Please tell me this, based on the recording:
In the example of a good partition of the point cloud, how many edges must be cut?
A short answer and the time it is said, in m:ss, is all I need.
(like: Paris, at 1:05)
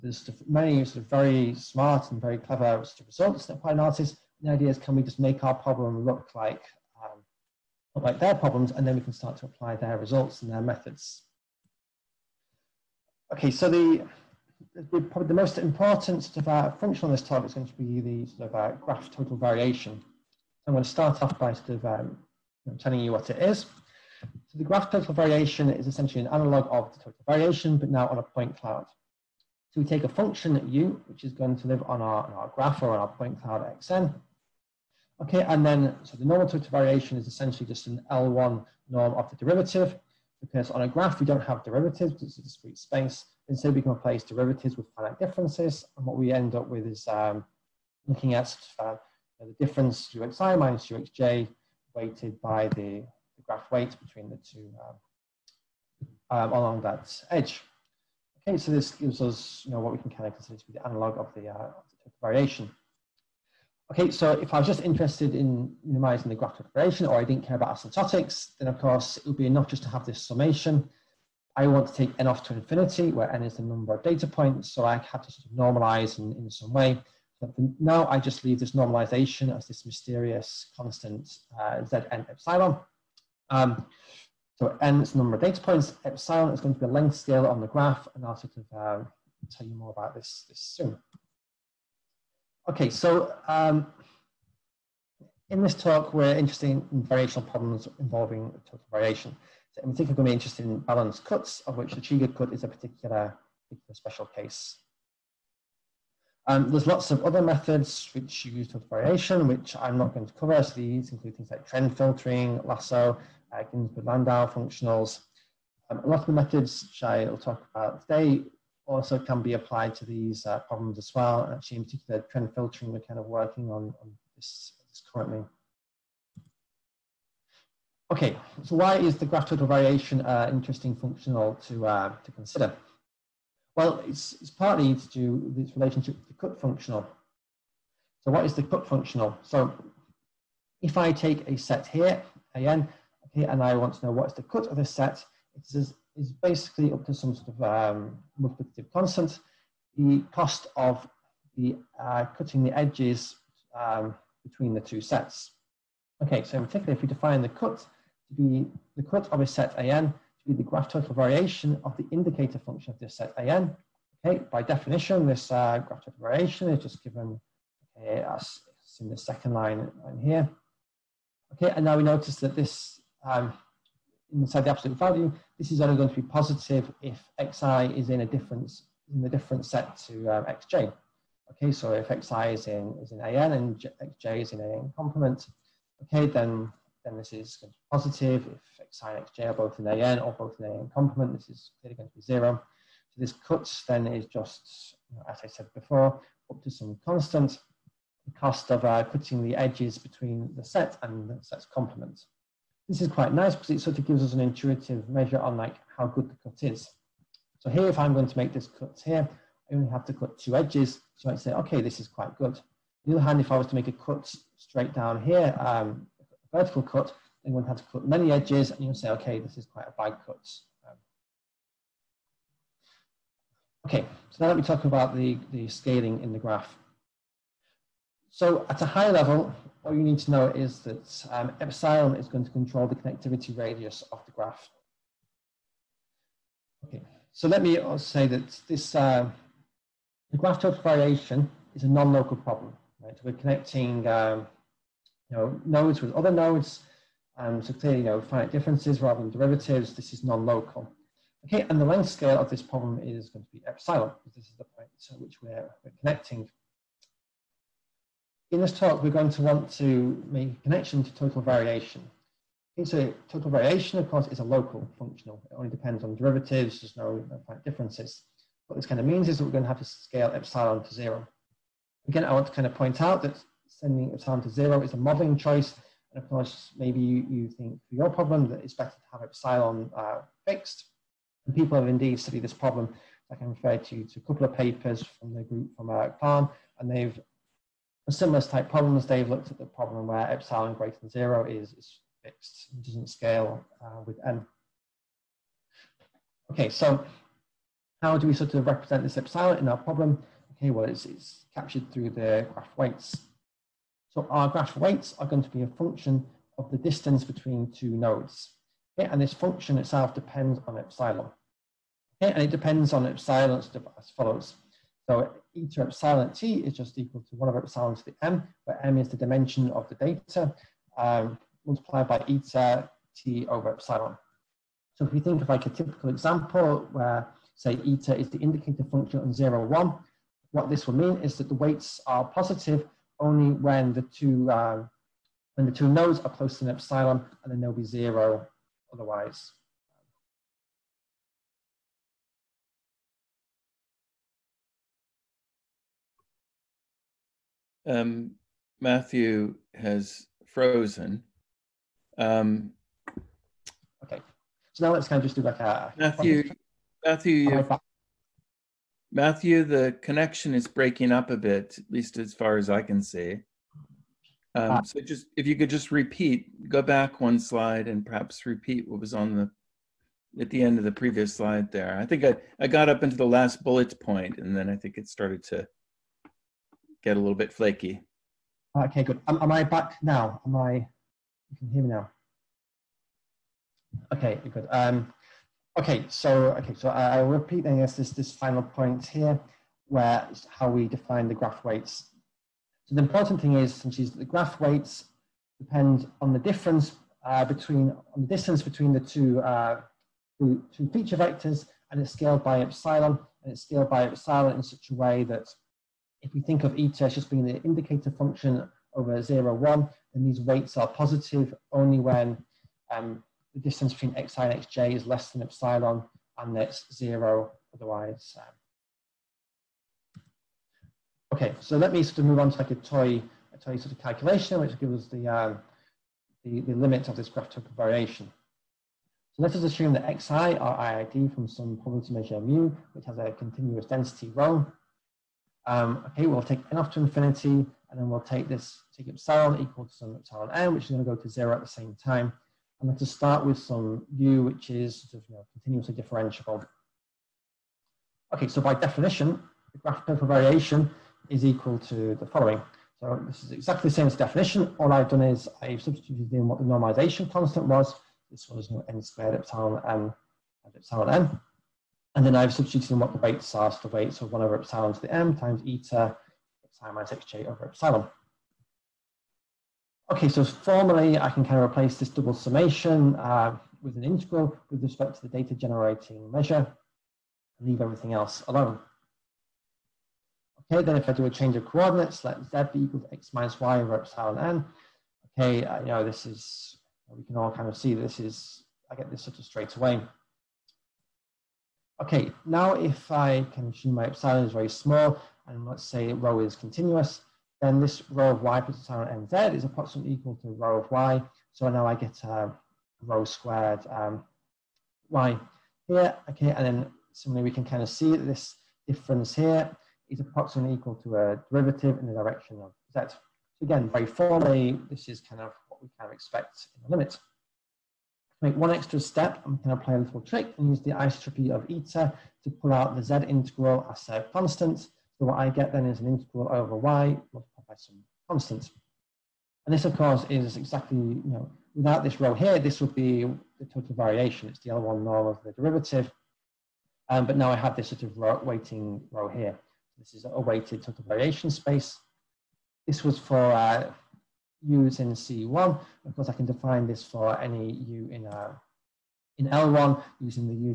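2, at 3:30.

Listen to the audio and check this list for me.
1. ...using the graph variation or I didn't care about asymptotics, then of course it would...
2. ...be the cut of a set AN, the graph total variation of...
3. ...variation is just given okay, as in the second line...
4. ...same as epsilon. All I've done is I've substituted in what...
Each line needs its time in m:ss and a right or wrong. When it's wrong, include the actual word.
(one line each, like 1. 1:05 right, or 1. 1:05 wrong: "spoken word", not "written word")
1. 1:05 wrong: "minimizing", not "using"
2. 2:38 right
3. 2:46 right
4. 7:33 wrong: "definition", not "epsilon".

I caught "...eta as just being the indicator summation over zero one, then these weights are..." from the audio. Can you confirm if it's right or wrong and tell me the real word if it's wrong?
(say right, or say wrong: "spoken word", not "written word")
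wrong: "function", not "summation".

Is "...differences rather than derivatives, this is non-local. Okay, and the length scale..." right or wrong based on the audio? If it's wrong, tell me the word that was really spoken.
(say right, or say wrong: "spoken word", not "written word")
right.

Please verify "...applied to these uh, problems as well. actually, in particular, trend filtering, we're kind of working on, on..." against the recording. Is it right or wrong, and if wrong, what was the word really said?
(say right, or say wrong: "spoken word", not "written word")
right.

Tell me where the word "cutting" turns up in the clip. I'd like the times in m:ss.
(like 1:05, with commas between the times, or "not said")
2:32, 3:19.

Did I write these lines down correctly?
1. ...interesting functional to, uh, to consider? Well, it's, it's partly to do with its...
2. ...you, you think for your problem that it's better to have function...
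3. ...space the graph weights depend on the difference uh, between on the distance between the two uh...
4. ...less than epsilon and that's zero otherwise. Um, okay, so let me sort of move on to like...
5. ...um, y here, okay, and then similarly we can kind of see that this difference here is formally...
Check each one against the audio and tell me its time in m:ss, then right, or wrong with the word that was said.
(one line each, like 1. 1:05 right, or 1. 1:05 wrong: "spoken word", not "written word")
1. 2:10 right
2. 4:37 wrong: "epsilon", not "function"
3. 6:33 wrong: "since", not "space"
4. 6:55 right
5. 8:23 wrong: "approximately", not "formally".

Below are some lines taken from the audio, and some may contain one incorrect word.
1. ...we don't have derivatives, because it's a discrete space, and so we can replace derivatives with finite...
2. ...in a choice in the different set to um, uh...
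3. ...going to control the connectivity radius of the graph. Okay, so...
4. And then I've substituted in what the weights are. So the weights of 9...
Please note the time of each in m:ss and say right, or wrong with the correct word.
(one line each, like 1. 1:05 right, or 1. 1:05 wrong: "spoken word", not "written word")
1. 0:41 right
2. 2:58 wrong: "difference", not "choice"
3. 3:52 right
4. 7:42 wrong: "1", not "9".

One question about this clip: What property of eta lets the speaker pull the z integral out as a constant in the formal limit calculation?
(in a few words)
isotropy.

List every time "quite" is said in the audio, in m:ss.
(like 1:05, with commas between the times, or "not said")
3:23, 3:32, 3:39.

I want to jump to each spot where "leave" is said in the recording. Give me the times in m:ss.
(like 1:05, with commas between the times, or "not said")
1:18, 7:57.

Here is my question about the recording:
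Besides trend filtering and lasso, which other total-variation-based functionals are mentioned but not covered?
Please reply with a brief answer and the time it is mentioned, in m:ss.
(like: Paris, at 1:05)
Ginzburg-Landau functionals, at 1:53.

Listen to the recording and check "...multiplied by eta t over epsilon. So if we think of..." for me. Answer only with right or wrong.
right.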